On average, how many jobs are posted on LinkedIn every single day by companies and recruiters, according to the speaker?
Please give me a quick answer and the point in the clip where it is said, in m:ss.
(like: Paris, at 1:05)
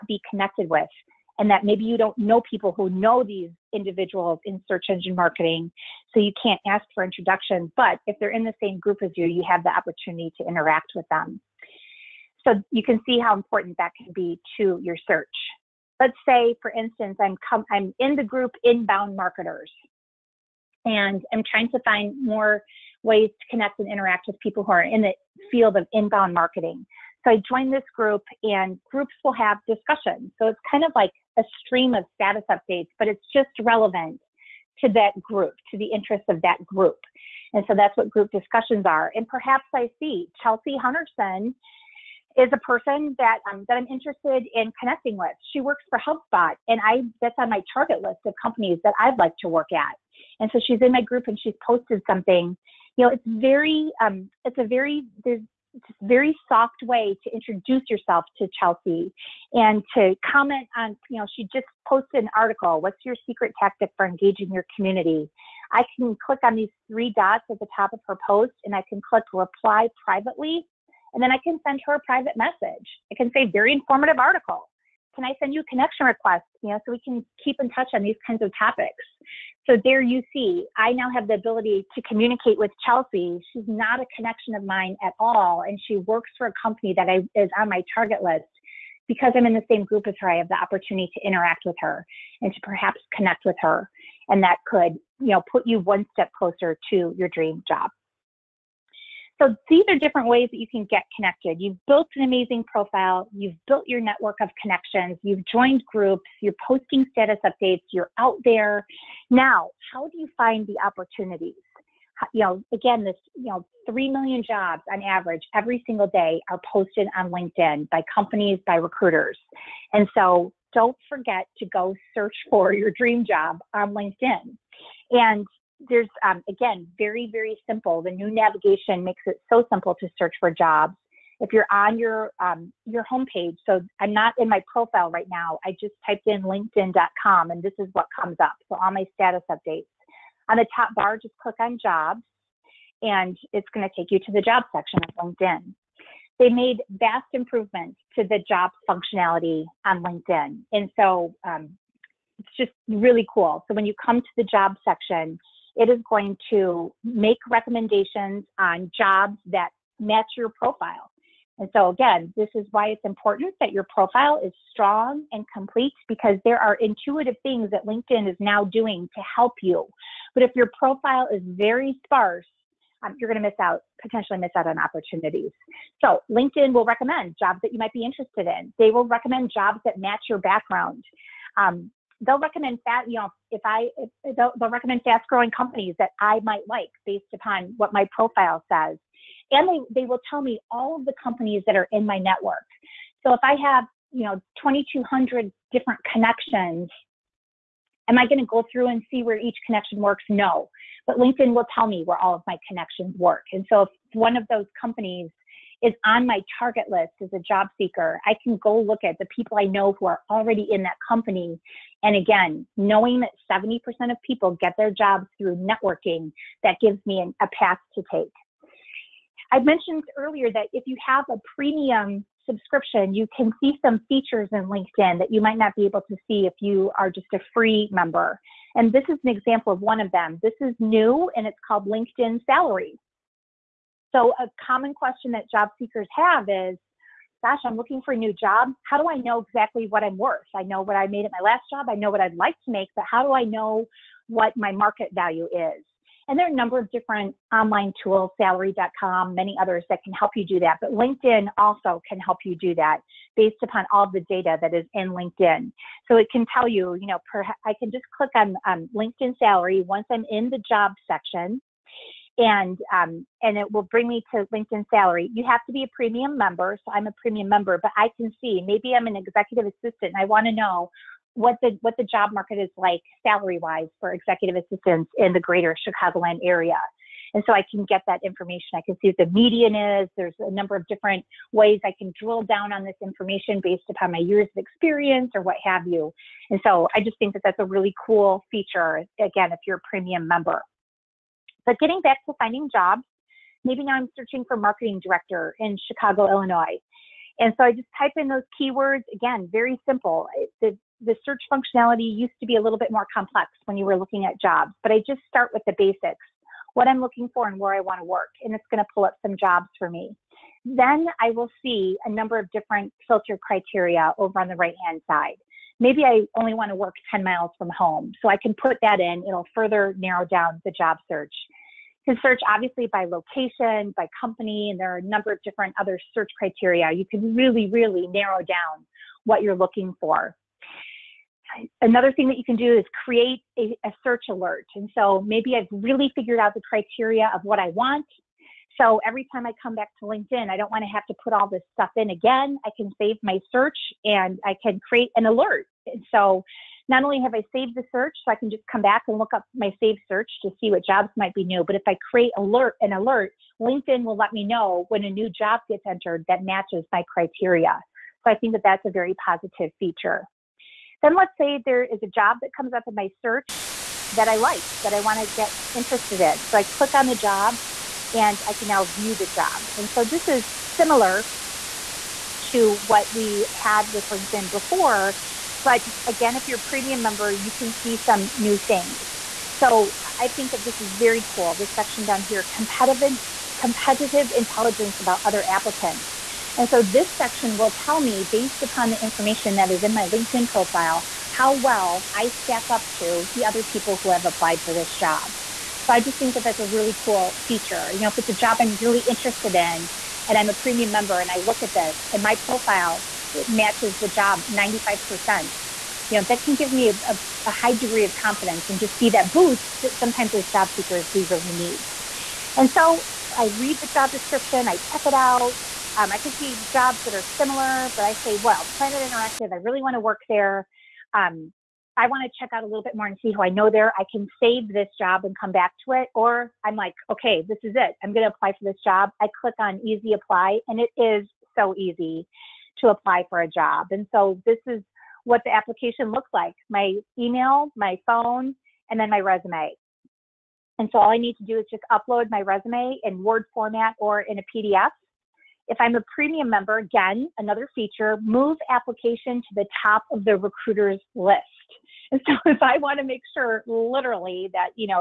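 3 million, at 1:53.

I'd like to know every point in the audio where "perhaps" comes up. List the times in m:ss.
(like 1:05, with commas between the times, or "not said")
0:39, 1:32.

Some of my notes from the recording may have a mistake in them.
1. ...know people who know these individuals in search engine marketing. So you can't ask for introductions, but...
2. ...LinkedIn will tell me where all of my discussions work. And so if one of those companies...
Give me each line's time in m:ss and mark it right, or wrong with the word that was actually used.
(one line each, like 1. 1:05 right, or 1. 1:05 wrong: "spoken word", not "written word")
1. 0:02 right
2. 3:21 wrong: "connections", not "discussions".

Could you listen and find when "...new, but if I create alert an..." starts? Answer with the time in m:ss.
5:51.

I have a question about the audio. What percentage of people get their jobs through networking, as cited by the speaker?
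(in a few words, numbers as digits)
70%.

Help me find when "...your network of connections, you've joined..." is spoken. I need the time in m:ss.
1:43.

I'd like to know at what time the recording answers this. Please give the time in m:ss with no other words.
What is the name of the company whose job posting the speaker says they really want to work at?
6:58.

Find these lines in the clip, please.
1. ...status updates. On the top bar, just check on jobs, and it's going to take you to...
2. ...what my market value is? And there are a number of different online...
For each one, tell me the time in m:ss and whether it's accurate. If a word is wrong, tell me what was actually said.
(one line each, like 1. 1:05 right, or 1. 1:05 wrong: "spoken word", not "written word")
1. 2:19 wrong: "click", not "check"
2. 4:04 right.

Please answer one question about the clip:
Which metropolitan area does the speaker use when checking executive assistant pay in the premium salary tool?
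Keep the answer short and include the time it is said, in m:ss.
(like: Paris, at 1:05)
greater Chicagoland area, at 4:35.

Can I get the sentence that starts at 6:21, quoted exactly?
This section down here, competitive, competitive intelligence about other applicants.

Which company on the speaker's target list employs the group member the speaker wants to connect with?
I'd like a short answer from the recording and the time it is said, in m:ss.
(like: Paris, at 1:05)
HubSpot, at 0:45.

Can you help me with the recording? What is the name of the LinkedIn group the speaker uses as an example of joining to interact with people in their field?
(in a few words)
inbound marketers.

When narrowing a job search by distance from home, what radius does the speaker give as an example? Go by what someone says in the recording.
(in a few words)
10 miles.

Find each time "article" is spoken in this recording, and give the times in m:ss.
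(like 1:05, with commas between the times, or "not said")
1:02, 1:14.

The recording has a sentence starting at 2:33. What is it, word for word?
So when you come to the job section, it is going to make recommendations on jobs that match your profile.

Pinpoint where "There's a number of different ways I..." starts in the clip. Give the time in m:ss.
4:40.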